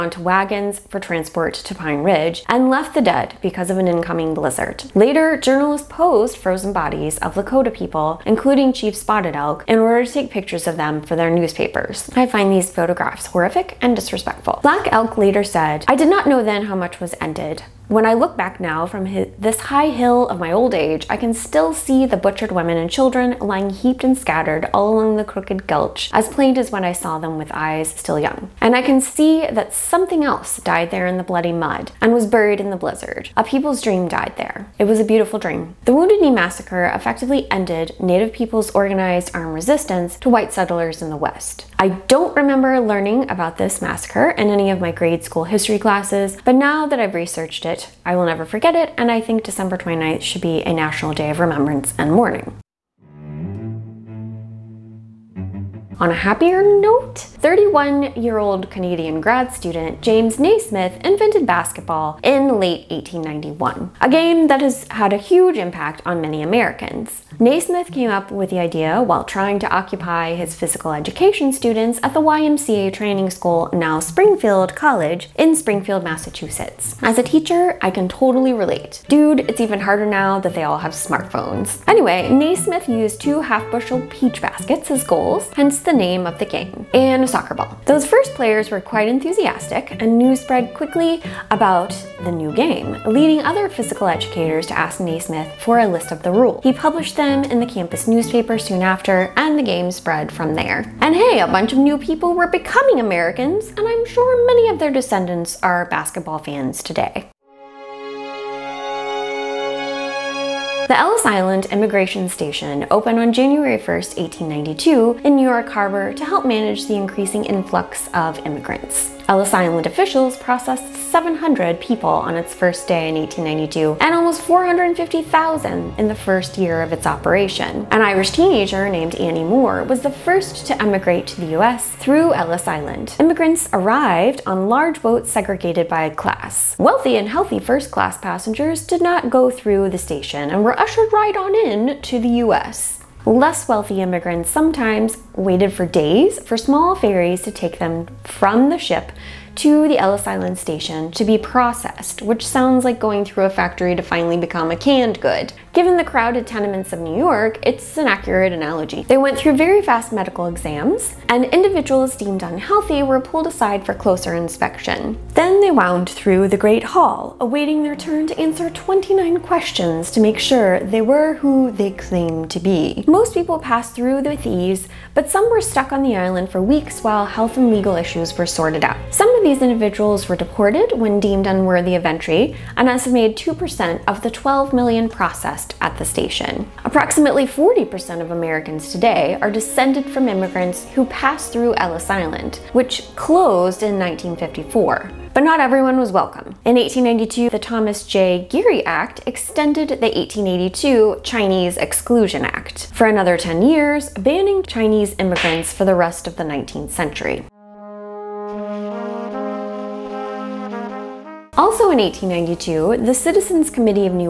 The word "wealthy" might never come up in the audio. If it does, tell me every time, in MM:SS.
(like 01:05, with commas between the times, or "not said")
02:16, 02:23.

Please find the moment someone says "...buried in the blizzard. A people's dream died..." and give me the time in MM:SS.
00:32.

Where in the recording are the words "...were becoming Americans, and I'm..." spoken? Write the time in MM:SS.
01:42.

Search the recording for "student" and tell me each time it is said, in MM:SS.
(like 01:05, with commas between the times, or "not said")
00:59, 01:11.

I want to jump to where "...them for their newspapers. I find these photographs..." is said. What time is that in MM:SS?
00:10.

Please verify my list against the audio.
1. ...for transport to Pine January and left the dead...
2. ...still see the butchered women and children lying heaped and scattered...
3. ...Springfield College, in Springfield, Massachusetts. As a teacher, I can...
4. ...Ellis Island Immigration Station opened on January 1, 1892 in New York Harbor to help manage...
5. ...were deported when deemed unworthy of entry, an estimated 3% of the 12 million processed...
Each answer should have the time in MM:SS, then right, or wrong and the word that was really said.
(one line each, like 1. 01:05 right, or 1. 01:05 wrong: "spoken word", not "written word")
1. 00:00 wrong: "Ridge", not "January"
2. 00:21 right
3. 01:13 right
4. 01:50 right
5. 03:00 wrong: "2", not "3".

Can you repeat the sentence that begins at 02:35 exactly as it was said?
Given the crowded tenements of New York, it's an accurate analogy.